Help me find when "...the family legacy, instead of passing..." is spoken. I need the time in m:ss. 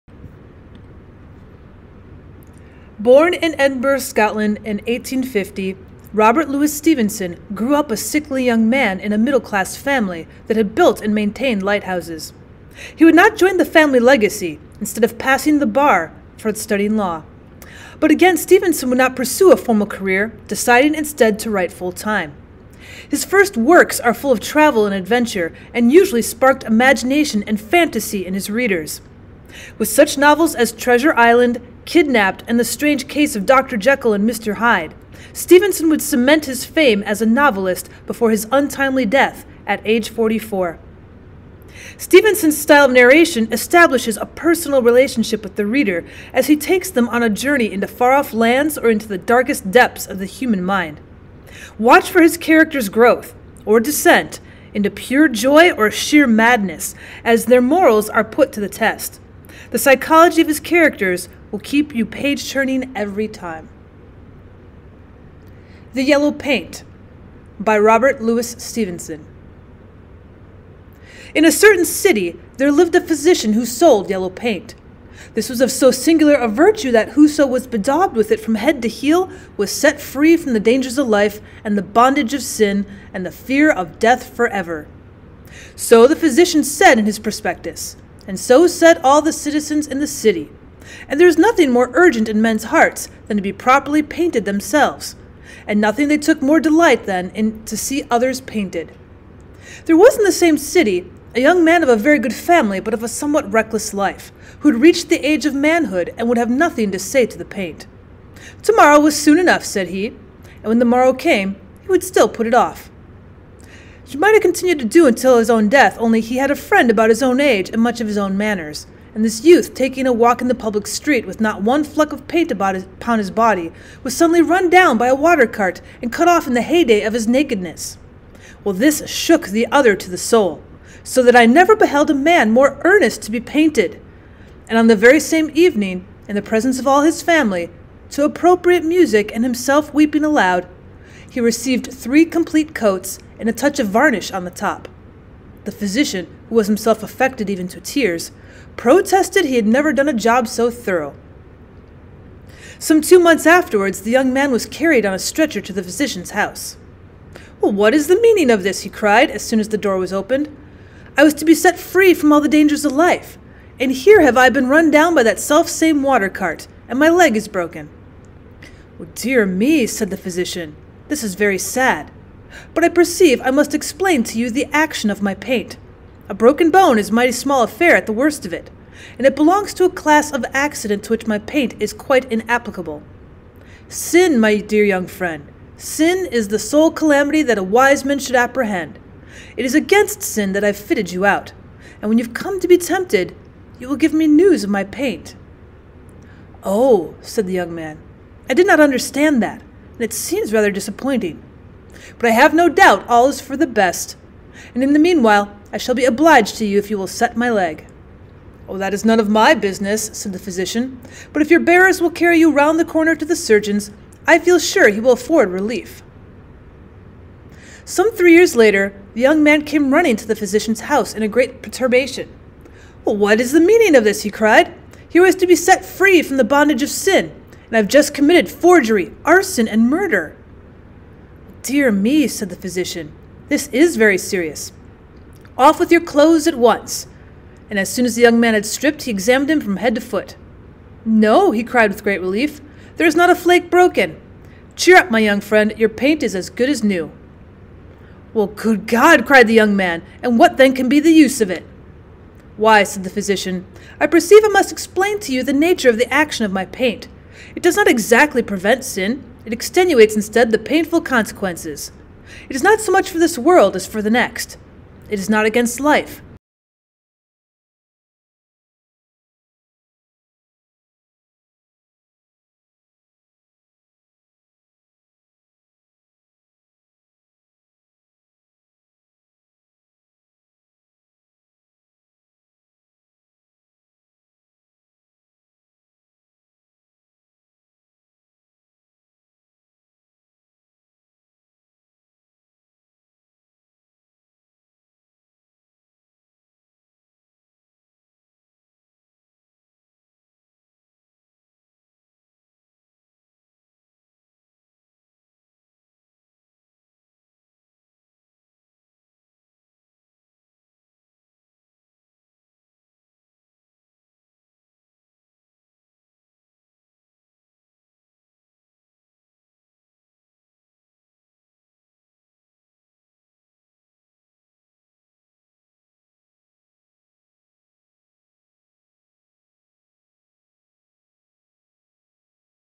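0:13.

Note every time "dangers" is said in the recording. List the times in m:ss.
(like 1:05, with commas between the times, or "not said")
1:20, 2:42.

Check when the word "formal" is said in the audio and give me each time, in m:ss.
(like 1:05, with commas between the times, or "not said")
0:19.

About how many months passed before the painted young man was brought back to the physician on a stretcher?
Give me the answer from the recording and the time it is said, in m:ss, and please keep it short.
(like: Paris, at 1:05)
2, at 2:33.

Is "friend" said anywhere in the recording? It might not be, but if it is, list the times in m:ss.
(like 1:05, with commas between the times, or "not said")
1:56, 3:05, 4:05.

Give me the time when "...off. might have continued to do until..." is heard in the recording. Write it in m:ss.
1:52.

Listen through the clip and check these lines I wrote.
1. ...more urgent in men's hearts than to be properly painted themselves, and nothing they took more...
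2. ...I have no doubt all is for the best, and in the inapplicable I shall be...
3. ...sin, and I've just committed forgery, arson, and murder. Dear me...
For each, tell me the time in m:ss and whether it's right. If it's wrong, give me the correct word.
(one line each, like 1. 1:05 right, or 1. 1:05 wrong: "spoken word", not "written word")
1. 1:31 right
2. 3:22 wrong: "meanwhile", not "inapplicable"
3. 3:46 right.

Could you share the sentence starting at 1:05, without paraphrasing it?
The Yellow Paint by Robert Louis Stevenson.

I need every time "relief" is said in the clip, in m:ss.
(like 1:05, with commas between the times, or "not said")
3:35, 4:02.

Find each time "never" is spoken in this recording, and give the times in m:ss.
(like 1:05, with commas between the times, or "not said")
2:11, 2:29.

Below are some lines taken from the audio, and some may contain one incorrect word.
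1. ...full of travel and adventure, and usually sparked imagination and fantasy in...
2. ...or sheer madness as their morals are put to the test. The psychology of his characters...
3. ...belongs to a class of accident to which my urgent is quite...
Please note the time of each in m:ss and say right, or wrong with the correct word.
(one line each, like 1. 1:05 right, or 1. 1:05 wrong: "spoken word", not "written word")
1. 0:24 right
2. 0:55 right
3. 2:59 wrong: "paint", not "urgent".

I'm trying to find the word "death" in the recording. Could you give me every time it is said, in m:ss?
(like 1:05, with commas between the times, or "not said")
0:39, 1:23, 1:55.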